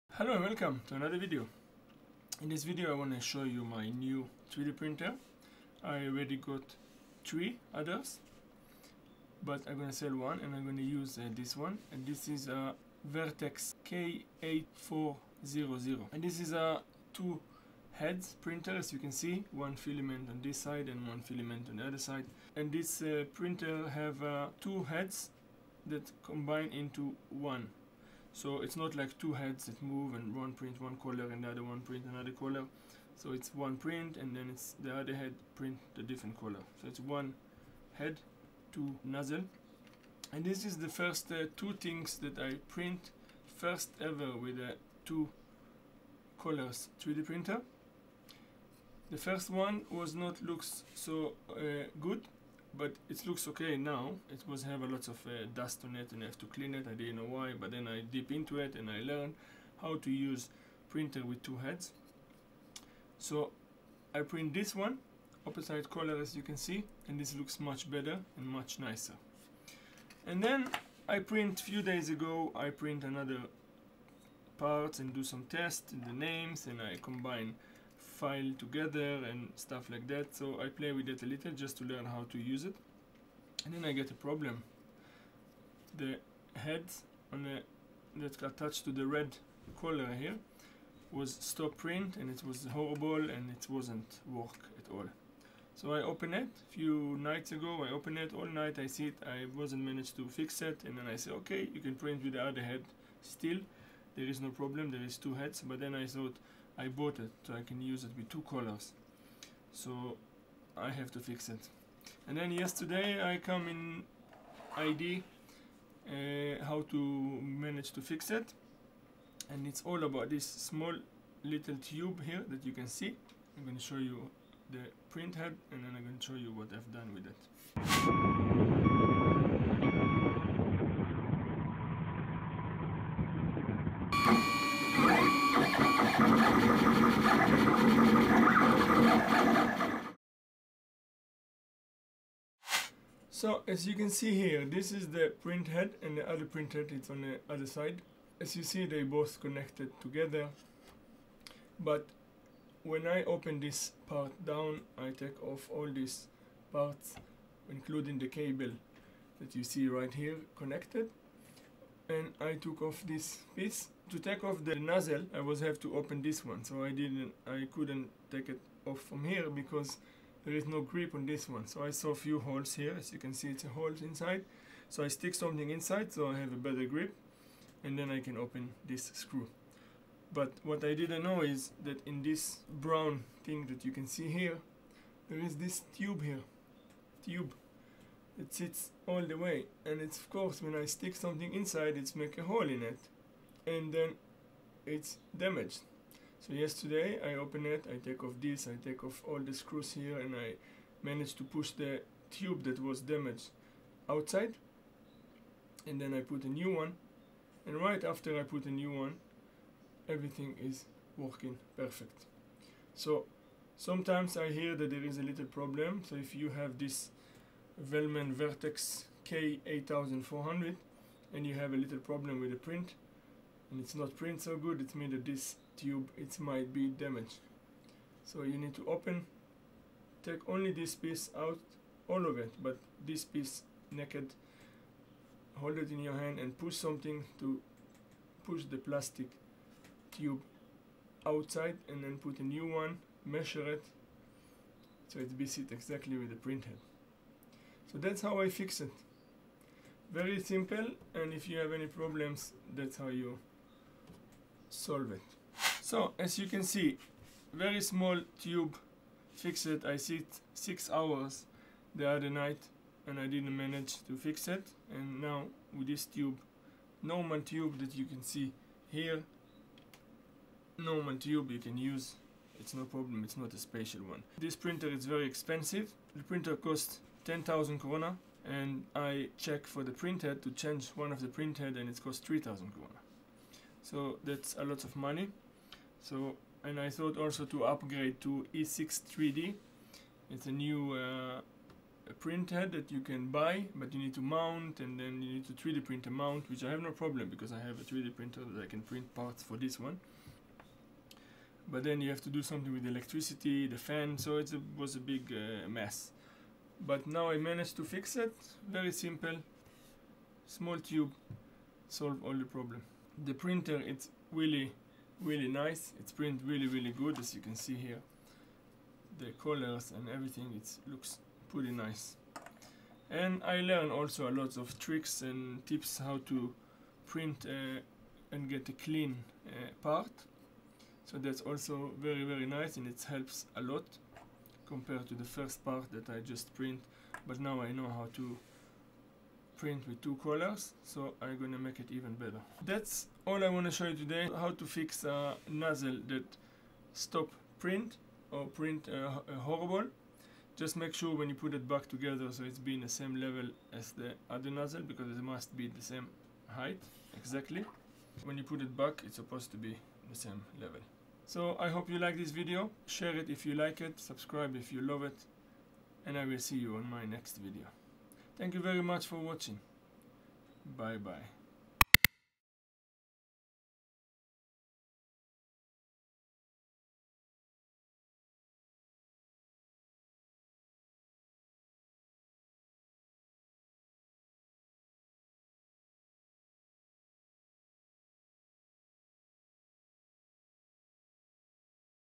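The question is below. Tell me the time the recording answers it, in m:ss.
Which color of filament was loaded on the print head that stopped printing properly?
1:29.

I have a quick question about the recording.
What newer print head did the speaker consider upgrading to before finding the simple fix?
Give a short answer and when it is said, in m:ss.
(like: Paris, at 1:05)
E6 3D, at 4:48.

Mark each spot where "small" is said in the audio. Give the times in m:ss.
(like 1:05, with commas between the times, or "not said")
2:00, 4:17, 5:10.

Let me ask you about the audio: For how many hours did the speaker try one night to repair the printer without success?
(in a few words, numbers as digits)
6.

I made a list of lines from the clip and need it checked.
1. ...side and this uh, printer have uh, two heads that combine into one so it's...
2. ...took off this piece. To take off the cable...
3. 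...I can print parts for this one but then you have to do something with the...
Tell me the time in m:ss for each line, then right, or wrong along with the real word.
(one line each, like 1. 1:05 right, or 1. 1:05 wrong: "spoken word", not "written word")
1. 0:21 right
2. 2:42 wrong: "nozzle", not "cable"
3. 4:58 right.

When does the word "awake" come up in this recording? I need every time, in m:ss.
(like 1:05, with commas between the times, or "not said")
not said.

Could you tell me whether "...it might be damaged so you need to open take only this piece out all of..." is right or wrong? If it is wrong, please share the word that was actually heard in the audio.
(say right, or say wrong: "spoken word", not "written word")
right.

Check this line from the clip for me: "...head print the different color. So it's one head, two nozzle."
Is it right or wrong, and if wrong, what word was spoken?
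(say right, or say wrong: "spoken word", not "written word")
right.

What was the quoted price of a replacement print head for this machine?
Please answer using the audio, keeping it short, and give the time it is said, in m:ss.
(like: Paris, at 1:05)
3,000 koruna, at 4:42.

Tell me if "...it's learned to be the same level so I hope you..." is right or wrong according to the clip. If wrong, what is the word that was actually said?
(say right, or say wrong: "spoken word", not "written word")
wrong: "supposed", not "learned".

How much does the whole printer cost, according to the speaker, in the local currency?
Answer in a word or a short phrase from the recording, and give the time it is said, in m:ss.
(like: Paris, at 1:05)
10,000 koruna, at 4:37.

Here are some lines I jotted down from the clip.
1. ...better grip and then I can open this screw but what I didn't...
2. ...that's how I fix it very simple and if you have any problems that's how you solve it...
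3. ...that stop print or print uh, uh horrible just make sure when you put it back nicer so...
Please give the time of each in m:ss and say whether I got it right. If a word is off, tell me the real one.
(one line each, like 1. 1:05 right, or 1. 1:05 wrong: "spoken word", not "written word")
1. 2:56 right
2. 4:07 right
3. 5:46 wrong: "together", not "nicer".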